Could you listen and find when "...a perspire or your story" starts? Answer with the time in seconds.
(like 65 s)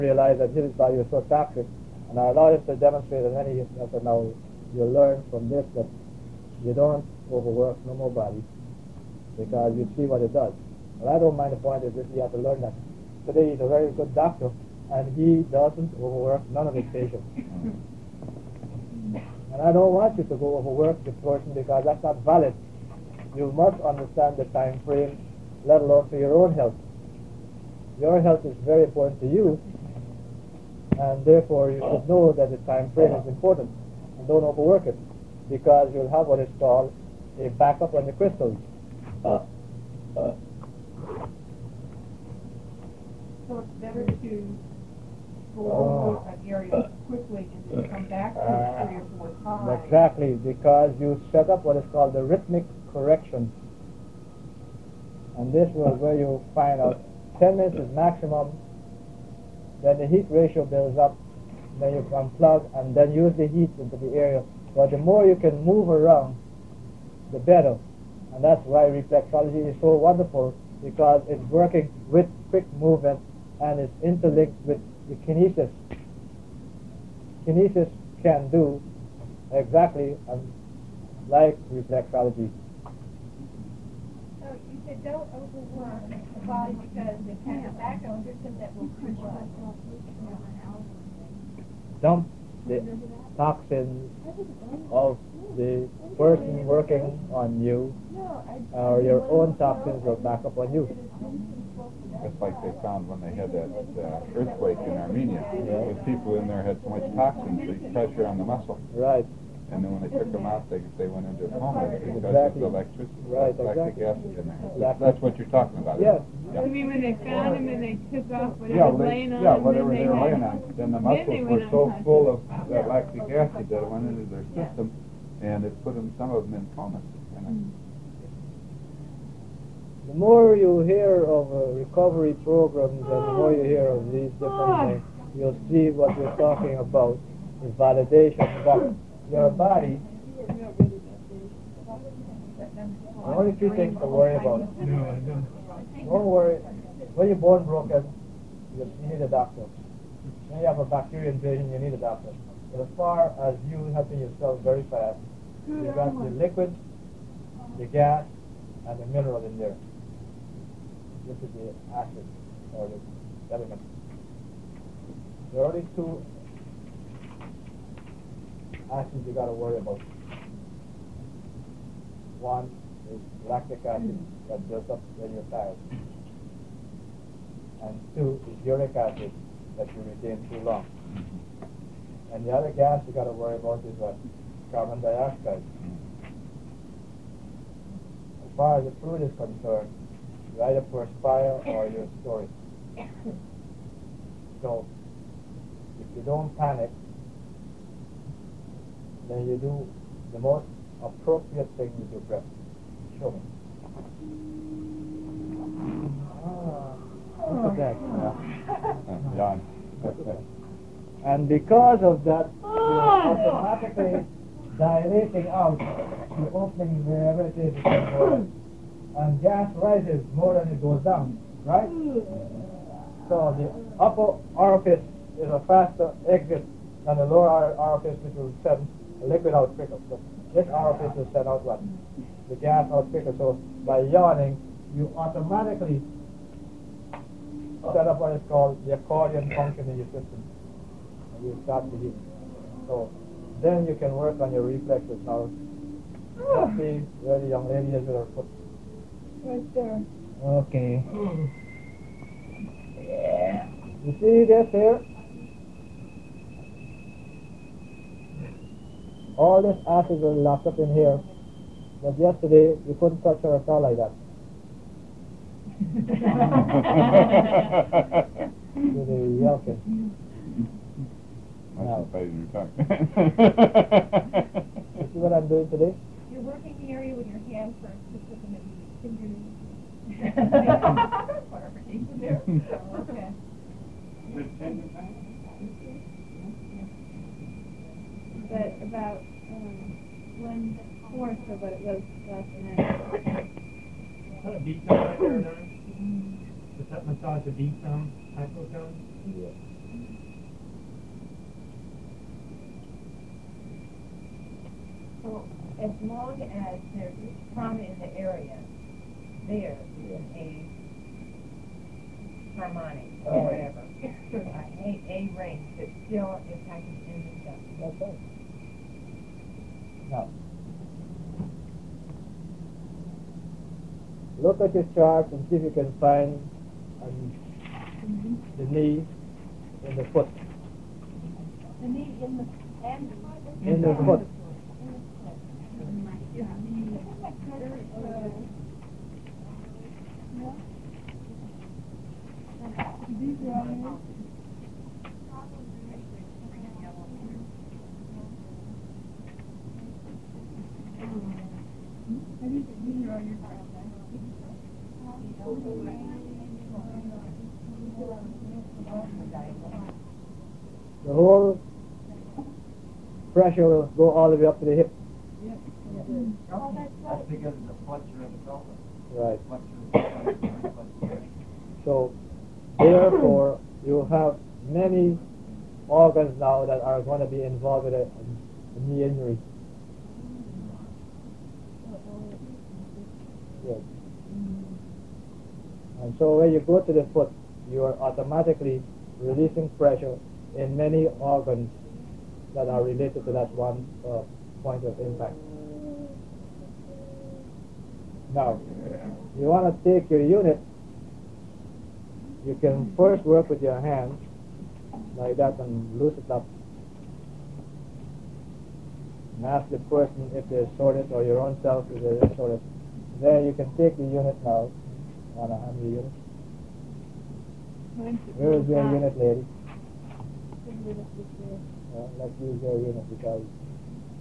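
190 s.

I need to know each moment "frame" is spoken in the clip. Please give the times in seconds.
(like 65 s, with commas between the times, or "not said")
24 s, 32 s.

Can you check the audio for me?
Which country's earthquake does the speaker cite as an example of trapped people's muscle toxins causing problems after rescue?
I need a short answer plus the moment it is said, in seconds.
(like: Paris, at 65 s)
Armenia, at 104 s.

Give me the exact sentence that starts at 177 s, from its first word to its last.
And two is uric acid that you retain too long.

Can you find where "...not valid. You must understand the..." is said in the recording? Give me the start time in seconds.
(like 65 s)
22 s.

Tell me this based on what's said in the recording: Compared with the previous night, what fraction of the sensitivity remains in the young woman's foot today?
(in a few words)
One fourth.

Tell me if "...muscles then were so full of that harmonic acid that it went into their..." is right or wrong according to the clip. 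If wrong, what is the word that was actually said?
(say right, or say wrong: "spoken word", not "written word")
wrong: "lactic", not "harmonic".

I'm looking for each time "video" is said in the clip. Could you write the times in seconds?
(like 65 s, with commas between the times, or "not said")
not said.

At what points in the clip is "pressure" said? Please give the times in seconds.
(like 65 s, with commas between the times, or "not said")
107 s, 363 s, 389 s.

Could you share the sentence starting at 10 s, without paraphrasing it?
Well, I don't mind the point is if you have to learn that.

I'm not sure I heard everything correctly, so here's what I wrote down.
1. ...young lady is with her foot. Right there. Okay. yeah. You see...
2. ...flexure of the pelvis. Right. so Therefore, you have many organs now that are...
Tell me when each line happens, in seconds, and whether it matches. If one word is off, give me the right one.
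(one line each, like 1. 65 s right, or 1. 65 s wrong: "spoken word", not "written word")
1. 247 s right
2. 367 s right.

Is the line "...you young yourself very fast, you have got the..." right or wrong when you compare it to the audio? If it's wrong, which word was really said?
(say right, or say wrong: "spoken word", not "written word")
wrong: "helping", not "young".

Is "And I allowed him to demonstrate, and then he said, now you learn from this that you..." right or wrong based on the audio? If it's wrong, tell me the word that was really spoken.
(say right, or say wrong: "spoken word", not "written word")
right.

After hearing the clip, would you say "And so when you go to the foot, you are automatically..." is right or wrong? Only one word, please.
right.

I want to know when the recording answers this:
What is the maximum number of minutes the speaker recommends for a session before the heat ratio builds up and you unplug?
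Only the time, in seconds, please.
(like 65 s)
57 s.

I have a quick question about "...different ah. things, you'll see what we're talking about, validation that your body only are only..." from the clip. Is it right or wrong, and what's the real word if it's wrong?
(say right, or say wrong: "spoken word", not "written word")
right.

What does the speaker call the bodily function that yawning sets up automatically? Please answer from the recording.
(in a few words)
Accordion function.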